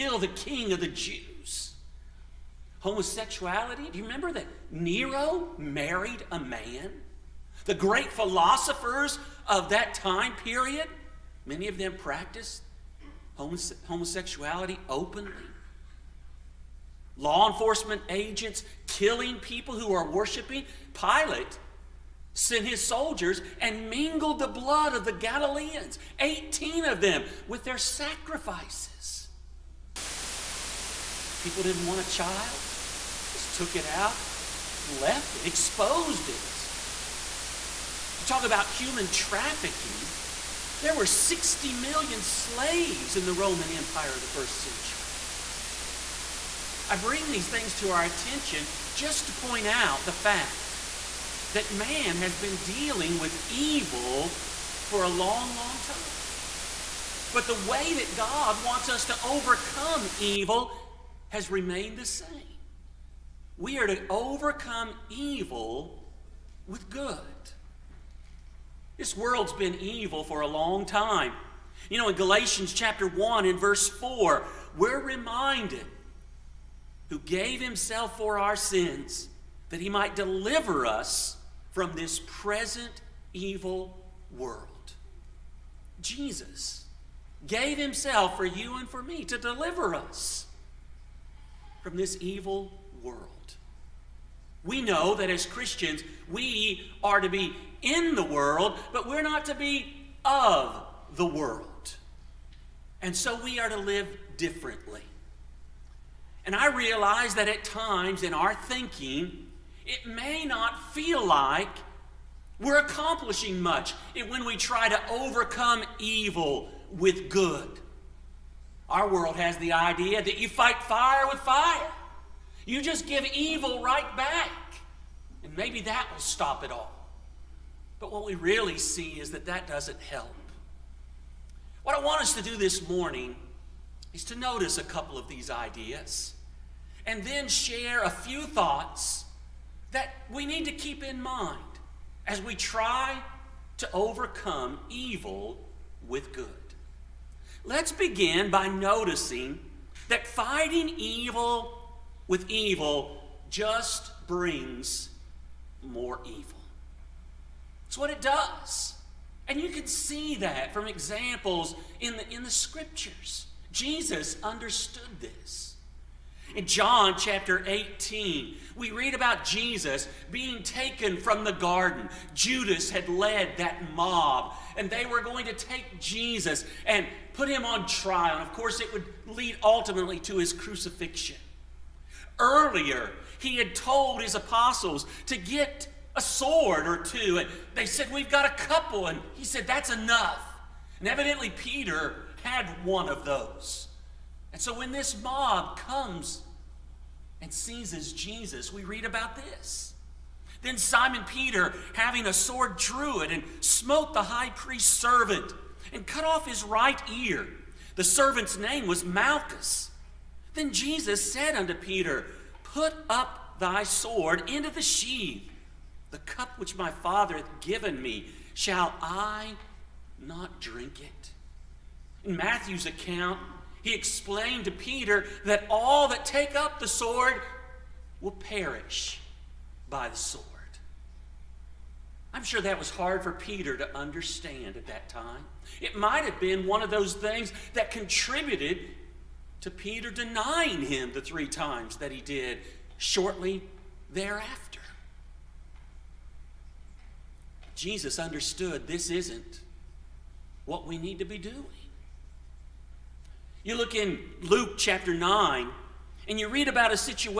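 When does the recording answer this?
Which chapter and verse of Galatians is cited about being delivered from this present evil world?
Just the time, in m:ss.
1:12.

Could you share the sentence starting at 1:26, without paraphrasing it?
Jesus gave himself for you and for me to deliver us from this evil world.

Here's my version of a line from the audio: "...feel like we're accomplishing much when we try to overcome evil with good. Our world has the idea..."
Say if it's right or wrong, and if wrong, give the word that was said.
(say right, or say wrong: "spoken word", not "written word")
right.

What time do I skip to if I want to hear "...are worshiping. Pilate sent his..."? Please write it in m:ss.
0:19.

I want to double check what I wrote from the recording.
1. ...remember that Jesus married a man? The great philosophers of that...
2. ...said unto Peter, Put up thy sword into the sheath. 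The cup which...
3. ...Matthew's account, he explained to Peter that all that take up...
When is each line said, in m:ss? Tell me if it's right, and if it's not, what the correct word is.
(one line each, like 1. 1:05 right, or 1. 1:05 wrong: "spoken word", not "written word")
1. 0:04 wrong: "Nero", not "Jesus"
2. 3:31 right
3. 3:42 right.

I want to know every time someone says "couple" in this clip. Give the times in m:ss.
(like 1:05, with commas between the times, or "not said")
2:14, 3:08.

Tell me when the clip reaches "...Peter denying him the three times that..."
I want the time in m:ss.
3:59.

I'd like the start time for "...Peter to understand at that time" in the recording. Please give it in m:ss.
3:53.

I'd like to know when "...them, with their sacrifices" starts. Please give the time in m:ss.
0:27.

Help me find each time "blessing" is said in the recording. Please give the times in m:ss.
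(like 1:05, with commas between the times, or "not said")
not said.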